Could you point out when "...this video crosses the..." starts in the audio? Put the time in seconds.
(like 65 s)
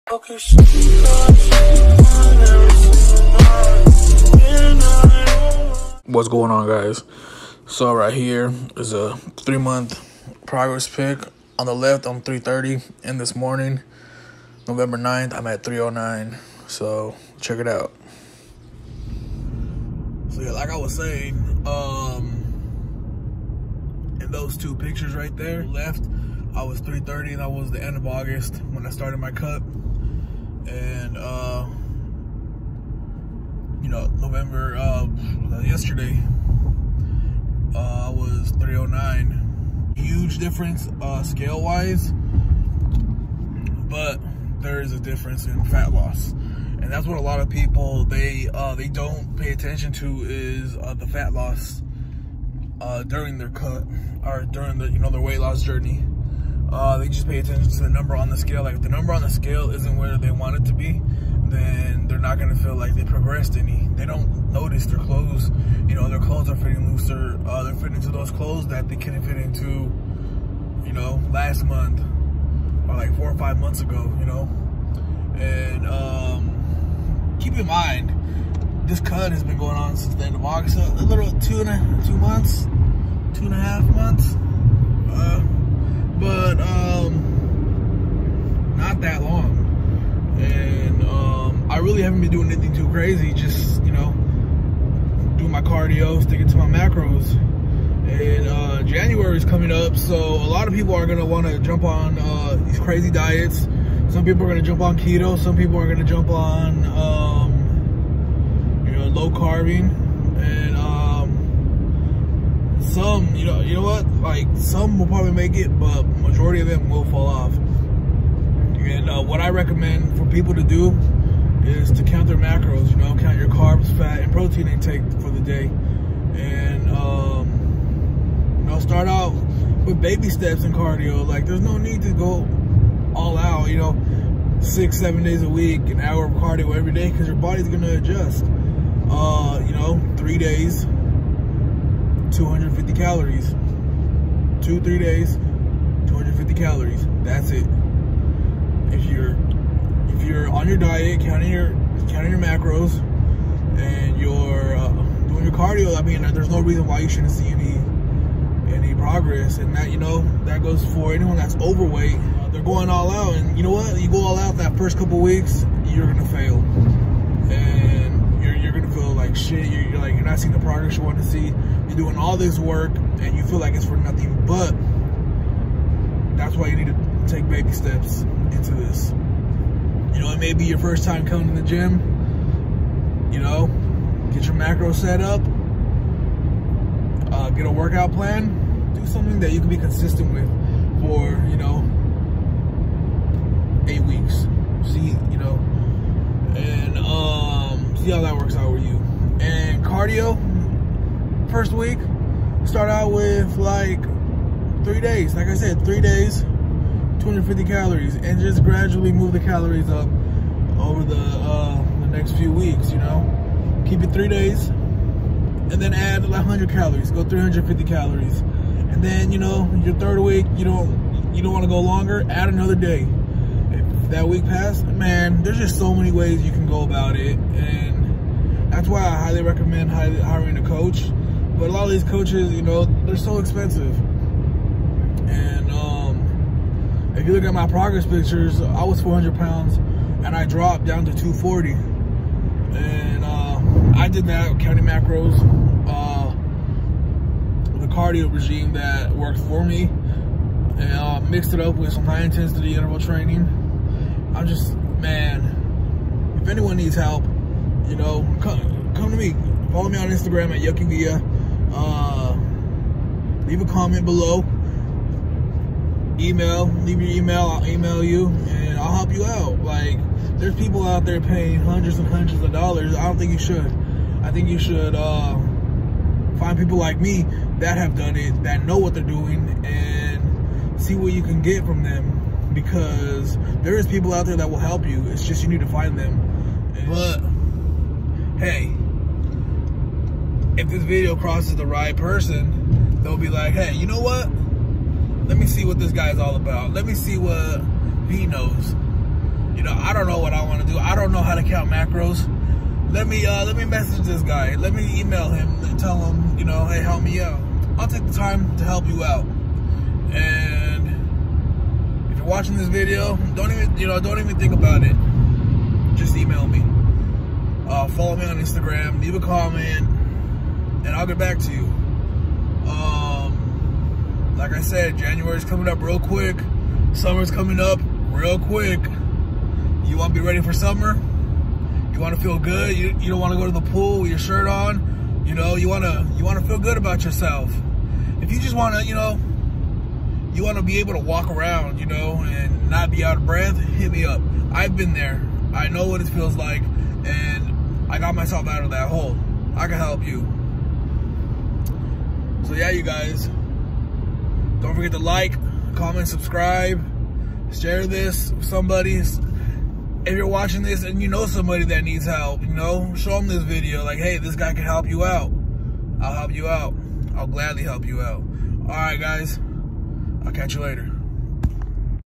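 290 s.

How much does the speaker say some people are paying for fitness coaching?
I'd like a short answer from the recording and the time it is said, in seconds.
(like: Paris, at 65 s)
hundreds and hundreds of dollars, at 271 s.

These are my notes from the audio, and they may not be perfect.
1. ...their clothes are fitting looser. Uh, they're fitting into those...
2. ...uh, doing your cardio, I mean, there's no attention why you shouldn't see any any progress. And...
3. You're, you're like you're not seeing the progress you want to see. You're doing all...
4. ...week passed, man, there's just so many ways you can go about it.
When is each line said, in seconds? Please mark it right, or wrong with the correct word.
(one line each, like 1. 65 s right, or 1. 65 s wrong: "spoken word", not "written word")
1. 66 s right
2. 154 s wrong: "reason", not "attention"
3. 169 s right
4. 224 s right.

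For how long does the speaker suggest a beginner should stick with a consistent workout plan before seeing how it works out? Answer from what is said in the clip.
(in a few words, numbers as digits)
8 weeks.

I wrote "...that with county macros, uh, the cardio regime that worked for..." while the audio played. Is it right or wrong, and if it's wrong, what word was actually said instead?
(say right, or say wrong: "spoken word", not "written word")
right.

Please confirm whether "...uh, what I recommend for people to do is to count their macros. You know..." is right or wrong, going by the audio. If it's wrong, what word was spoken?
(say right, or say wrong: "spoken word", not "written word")
right.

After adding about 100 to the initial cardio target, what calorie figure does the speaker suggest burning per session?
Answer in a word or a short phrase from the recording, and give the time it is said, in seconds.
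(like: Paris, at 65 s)
350 calories, at 217 s.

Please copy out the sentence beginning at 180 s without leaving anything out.
You know, it may be your first time coming to the gym.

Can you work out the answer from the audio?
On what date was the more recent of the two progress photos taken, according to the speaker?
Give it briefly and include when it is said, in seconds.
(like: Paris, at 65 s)
November 9th, at 14 s.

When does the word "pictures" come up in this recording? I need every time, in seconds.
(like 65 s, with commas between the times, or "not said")
24 s, 238 s.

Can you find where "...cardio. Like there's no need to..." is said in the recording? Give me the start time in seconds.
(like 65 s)
130 s.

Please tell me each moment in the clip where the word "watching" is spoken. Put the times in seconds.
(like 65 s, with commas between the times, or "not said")
312 s, 360 s.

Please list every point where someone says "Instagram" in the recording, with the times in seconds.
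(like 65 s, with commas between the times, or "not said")
260 s, 318 s.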